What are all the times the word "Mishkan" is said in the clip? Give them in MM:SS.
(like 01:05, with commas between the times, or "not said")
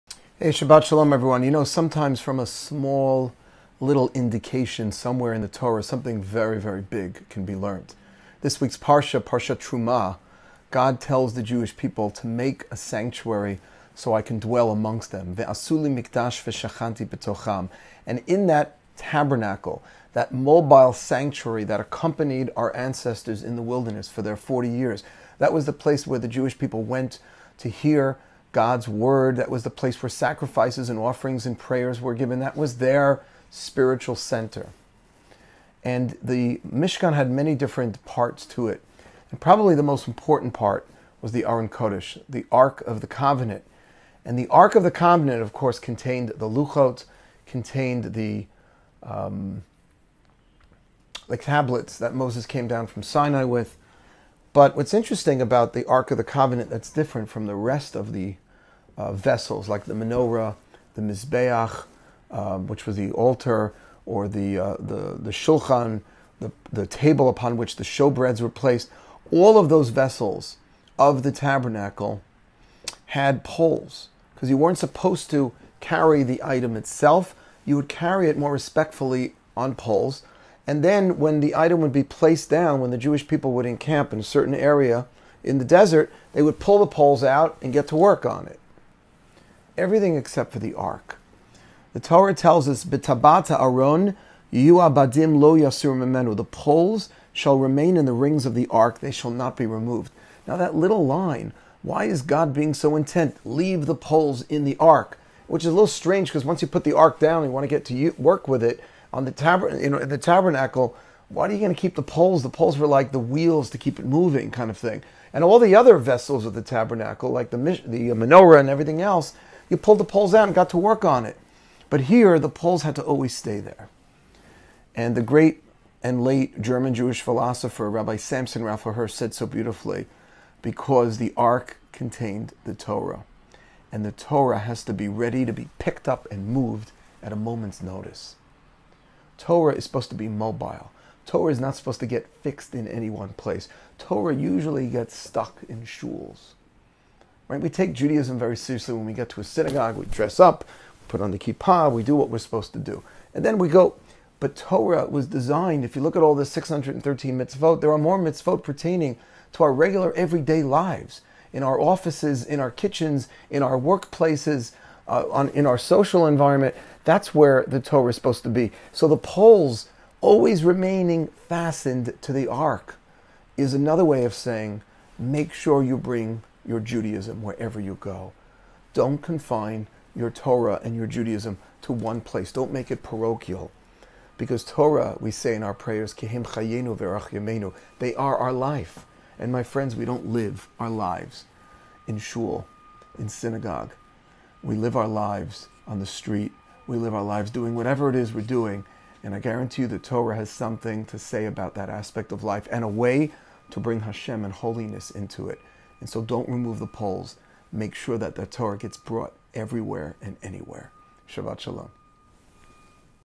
00:36.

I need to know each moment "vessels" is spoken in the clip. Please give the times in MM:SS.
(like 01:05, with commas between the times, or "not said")
00:59, 01:09, 01:55.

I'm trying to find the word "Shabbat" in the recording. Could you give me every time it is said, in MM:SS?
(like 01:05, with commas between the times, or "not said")
00:00, 03:31.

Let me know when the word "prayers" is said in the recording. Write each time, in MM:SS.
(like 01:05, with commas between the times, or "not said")
00:31, 03:05.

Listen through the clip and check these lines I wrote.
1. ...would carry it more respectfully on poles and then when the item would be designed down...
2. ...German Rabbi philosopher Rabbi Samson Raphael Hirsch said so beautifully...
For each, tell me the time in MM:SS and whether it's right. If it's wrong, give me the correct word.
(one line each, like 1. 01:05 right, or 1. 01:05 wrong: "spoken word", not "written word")
1. 01:17 wrong: "placed", not "designed"
2. 02:06 wrong: "Jewish", not "Rabbi".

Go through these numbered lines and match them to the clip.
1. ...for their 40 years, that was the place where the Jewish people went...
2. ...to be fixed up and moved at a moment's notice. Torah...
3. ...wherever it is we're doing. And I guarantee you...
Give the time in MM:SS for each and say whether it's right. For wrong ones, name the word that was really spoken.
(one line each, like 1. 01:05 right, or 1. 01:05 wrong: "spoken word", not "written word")
1. 00:24 right
2. 02:15 wrong: "picked", not "fixed"
3. 03:17 wrong: "whatever", not "wherever".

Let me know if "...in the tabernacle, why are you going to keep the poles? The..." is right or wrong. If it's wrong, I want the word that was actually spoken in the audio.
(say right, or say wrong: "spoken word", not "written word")
right.